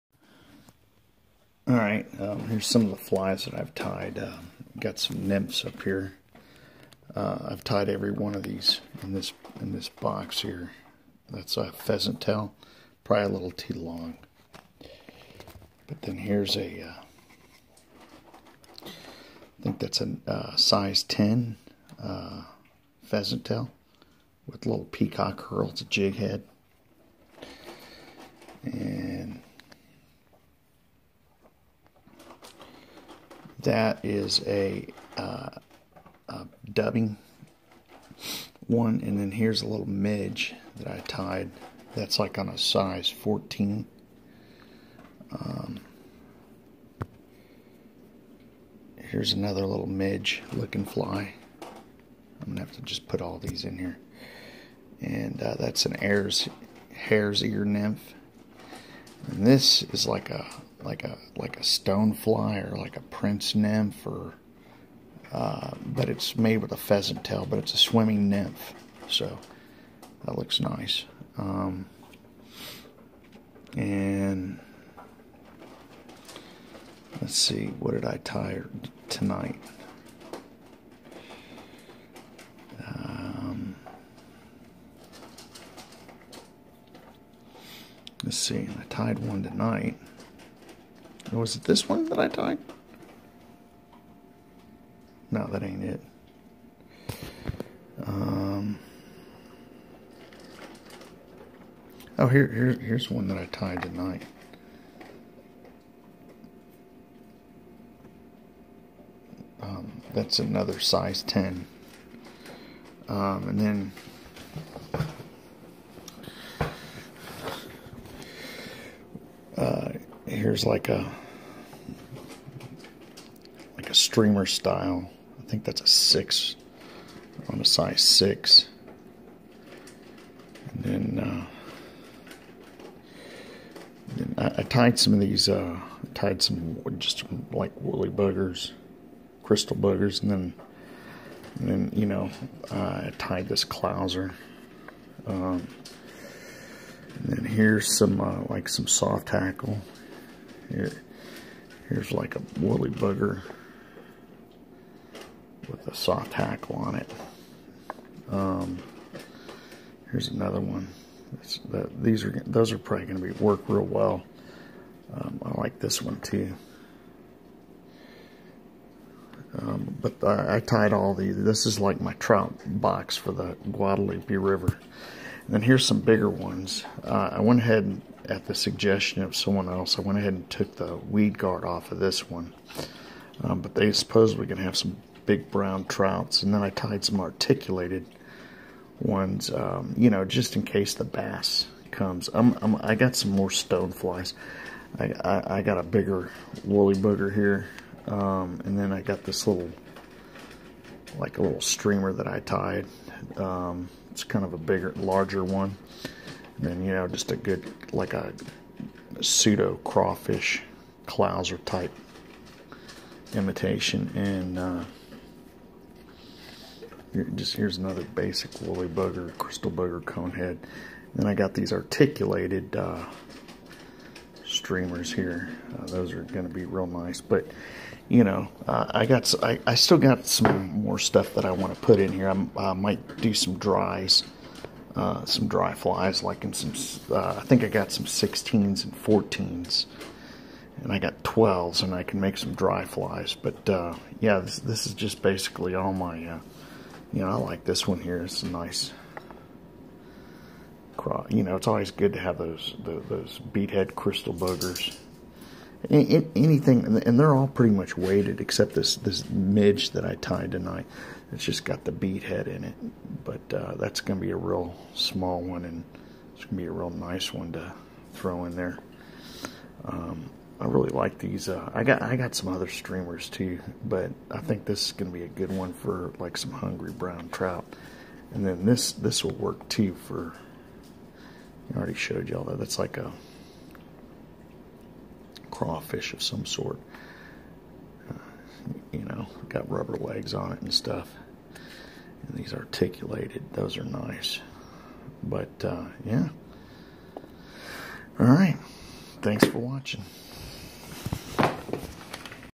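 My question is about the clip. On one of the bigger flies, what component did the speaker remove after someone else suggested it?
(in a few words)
weed guard.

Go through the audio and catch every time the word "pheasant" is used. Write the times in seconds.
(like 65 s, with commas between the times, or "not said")
11 s, 23 s, 66 s.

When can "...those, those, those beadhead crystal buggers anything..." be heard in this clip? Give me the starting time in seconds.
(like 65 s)
252 s.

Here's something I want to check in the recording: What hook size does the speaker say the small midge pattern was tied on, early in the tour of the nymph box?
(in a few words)
14.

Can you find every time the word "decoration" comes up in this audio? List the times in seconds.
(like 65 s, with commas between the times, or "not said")
not said.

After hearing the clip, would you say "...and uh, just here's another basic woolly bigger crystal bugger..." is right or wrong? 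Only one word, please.
wrong.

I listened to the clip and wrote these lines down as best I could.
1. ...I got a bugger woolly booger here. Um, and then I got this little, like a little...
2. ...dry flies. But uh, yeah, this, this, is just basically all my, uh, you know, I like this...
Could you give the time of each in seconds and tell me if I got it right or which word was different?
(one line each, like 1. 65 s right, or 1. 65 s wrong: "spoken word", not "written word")
1. 195 s wrong: "bigger", not "bugger"
2. 242 s right.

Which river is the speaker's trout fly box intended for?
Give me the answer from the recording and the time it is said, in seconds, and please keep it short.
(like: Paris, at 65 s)
Guadalupe River, at 173 s.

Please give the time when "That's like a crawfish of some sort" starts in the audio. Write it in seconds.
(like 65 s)
282 s.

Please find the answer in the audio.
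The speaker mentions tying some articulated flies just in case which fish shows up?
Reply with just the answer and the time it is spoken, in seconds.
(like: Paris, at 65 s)
bass, at 191 s.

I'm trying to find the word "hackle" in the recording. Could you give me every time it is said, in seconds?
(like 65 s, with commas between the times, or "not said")
149 s, 156 s.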